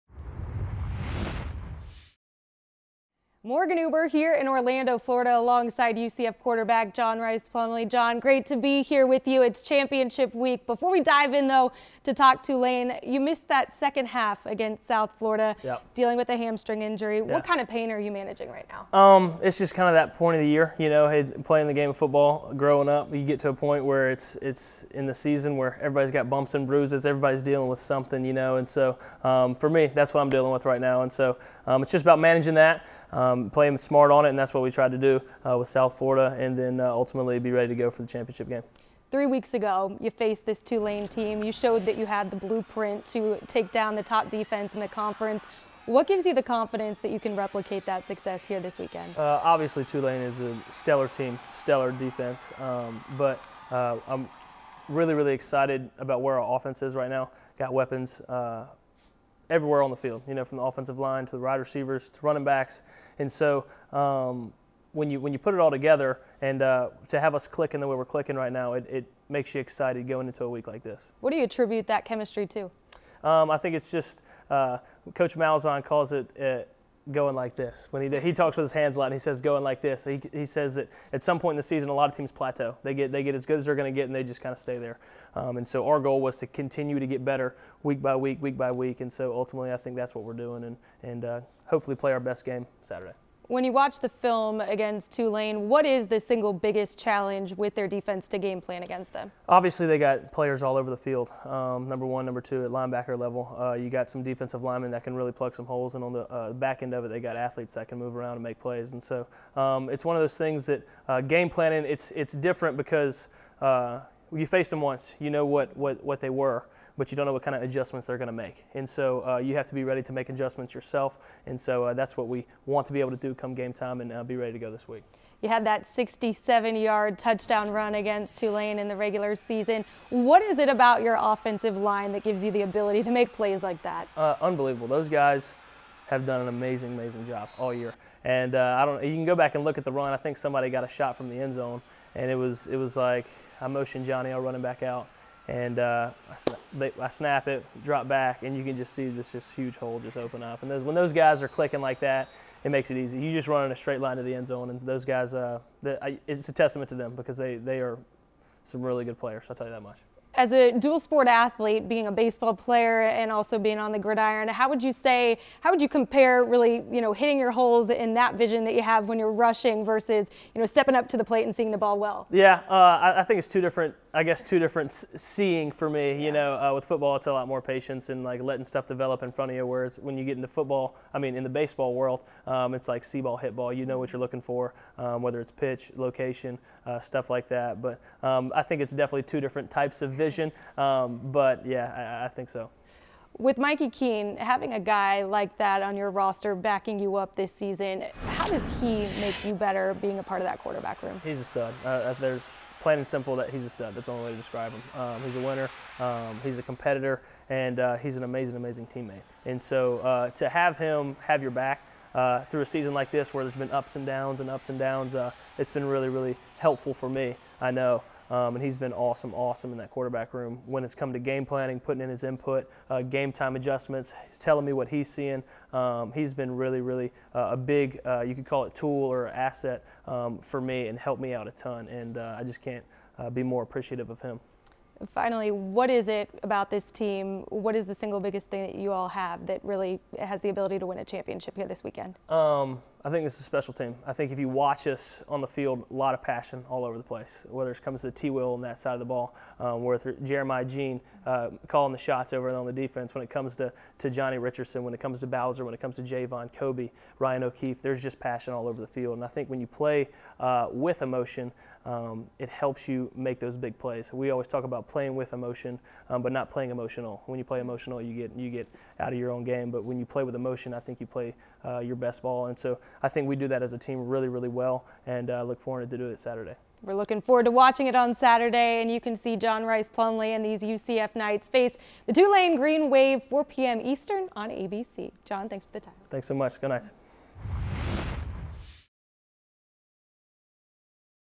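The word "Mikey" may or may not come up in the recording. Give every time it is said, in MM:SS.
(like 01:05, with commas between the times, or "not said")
03:13.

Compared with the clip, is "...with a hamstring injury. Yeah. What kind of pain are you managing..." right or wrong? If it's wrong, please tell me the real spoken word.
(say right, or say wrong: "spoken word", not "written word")
right.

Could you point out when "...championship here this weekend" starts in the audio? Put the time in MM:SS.
04:01.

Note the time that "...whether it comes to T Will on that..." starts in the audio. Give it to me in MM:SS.
04:07.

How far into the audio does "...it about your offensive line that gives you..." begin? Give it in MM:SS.
02:10.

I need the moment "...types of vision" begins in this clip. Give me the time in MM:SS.
03:09.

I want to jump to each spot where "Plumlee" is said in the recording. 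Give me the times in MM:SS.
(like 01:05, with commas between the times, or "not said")
00:07, 04:39.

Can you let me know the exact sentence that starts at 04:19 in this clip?
And I think when you play uh, with emotion, um, it helps you make those big plays.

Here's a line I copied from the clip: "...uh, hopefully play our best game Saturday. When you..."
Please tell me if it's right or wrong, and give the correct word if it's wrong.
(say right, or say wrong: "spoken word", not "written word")
right.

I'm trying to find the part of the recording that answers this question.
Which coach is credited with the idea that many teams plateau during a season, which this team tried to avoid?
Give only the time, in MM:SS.
01:15.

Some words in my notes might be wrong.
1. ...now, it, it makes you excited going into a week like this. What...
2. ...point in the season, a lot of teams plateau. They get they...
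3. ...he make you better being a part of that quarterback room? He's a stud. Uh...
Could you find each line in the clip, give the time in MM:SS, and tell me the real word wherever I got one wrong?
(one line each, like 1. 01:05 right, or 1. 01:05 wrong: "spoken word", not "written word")
1. 01:08 right
2. 01:21 right
3. 03:18 right.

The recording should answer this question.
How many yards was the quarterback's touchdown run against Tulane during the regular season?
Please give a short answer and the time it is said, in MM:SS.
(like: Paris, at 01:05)
67, at 02:05.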